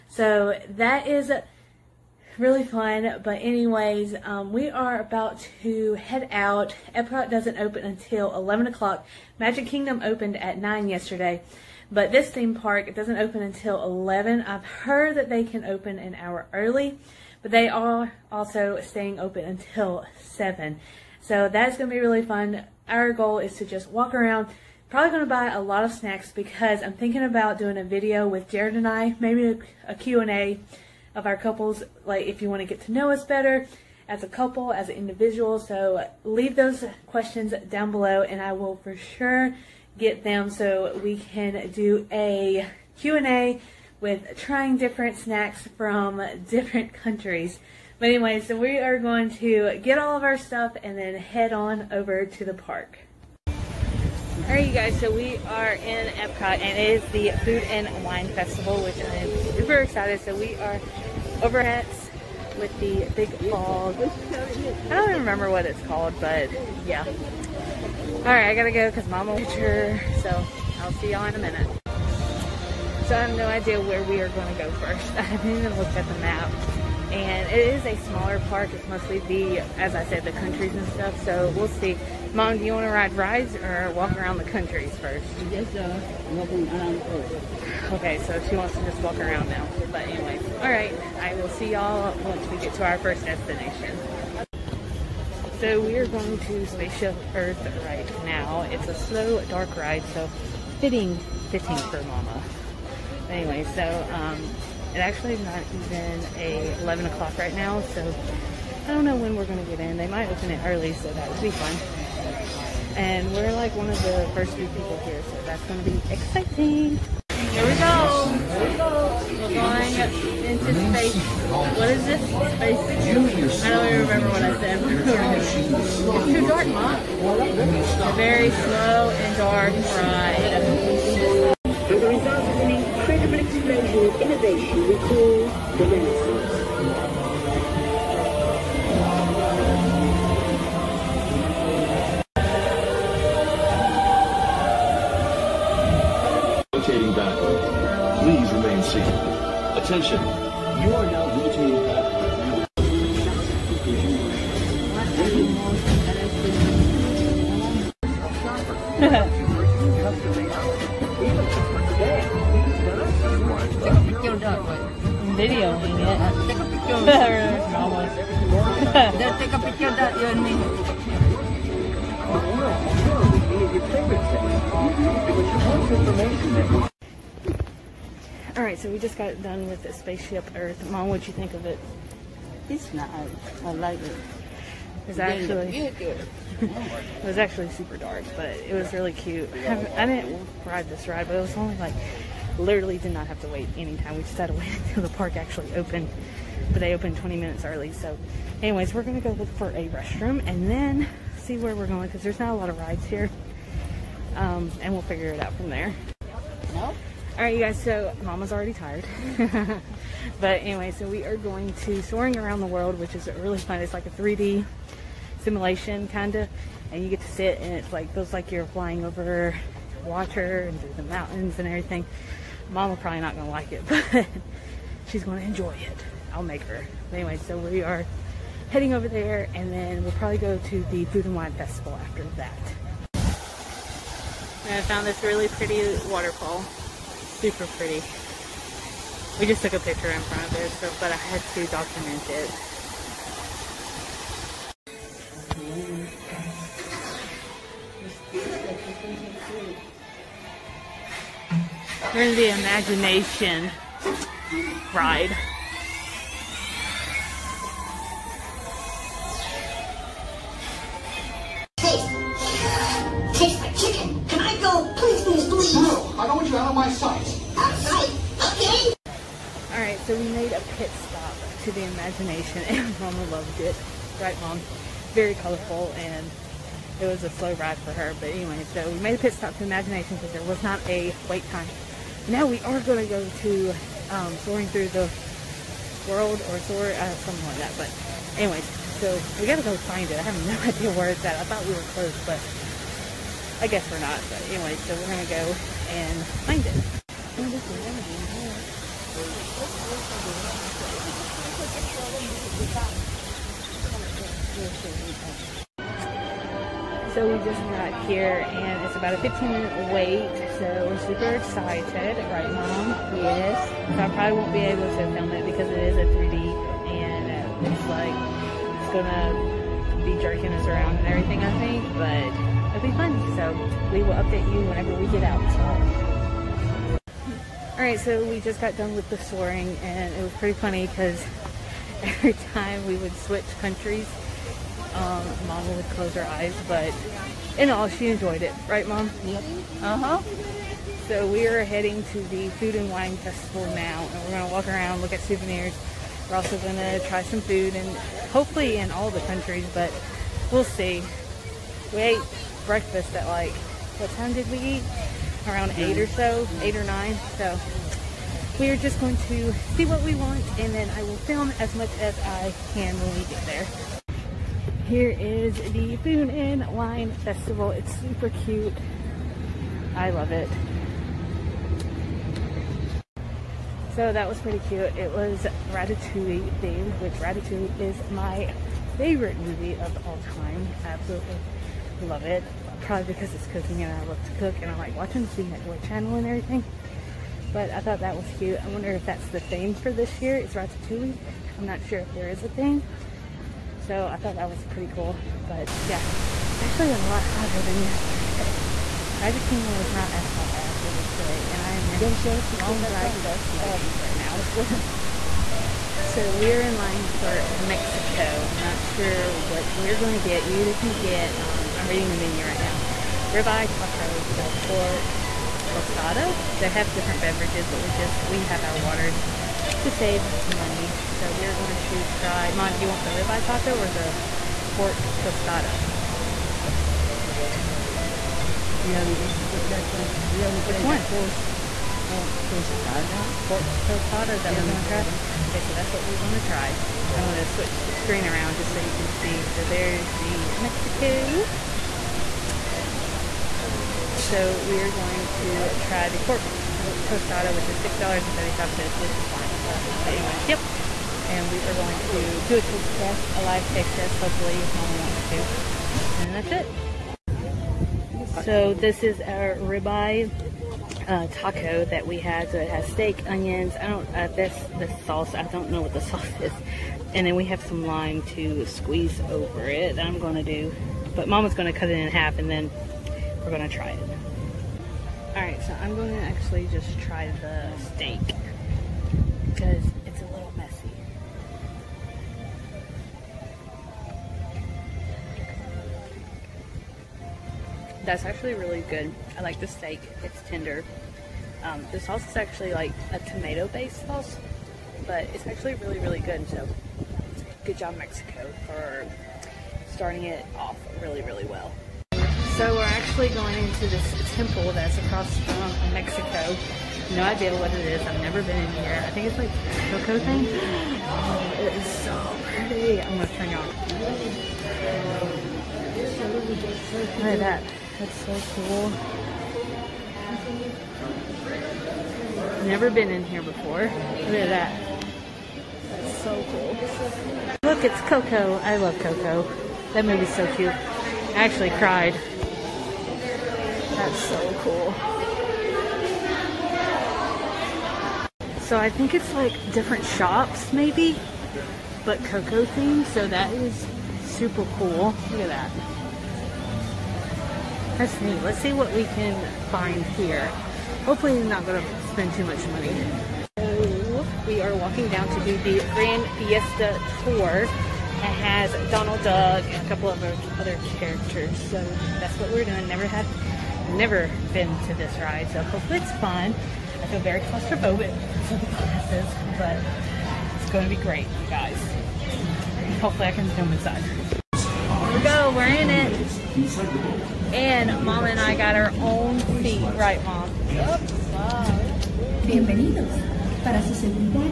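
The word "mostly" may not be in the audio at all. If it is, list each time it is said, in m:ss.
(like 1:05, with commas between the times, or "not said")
1:18.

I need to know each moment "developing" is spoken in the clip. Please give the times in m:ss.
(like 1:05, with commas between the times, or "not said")
not said.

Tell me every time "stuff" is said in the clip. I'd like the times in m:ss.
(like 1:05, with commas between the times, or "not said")
0:50, 1:20.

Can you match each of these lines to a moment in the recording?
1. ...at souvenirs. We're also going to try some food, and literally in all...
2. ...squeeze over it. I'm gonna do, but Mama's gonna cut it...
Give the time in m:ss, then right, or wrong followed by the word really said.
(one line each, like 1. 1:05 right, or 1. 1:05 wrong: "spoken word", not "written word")
1. 5:45 wrong: "hopefully", not "literally"
2. 7:48 right.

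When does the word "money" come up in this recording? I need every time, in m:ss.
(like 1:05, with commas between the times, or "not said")
7:00, 9:12.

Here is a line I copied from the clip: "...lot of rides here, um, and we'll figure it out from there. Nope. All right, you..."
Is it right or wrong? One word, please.
right.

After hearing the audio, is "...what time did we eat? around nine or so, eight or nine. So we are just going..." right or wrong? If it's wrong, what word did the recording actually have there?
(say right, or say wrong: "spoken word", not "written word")
wrong: "eight", not "nine".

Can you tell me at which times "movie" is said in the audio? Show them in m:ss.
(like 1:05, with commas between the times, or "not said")
6:19, 8:50.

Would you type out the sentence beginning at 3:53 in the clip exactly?
And I found this really pretty waterfall super pretty.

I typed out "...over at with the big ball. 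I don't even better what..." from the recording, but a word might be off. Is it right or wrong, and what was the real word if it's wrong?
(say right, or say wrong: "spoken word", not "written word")
wrong: "remember", not "better".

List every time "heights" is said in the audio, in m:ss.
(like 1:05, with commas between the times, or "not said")
not said.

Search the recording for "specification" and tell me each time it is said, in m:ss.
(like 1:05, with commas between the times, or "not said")
not said.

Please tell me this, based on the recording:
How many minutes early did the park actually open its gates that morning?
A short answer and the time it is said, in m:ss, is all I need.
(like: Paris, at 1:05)
20 minutes, at 3:17.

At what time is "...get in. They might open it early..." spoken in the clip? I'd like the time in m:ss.
1:49.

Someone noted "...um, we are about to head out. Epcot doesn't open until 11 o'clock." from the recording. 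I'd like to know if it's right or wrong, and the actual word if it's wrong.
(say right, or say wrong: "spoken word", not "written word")
right.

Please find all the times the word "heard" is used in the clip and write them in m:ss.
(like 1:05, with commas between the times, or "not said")
0:14.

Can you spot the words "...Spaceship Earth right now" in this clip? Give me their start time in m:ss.
1:36.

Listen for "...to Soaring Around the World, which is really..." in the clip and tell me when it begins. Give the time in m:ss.
3:31.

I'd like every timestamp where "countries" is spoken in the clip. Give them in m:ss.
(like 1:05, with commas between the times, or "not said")
0:46, 1:20, 1:24, 5:33, 5:49.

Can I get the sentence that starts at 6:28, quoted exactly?
I wonder if that's the theme for this year.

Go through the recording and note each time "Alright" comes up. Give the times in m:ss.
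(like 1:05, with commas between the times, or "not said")
2:58, 5:27.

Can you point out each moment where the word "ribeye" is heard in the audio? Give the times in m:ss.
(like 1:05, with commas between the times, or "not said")
6:53, 7:03, 7:39.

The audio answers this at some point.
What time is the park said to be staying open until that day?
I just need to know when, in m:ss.
0:20.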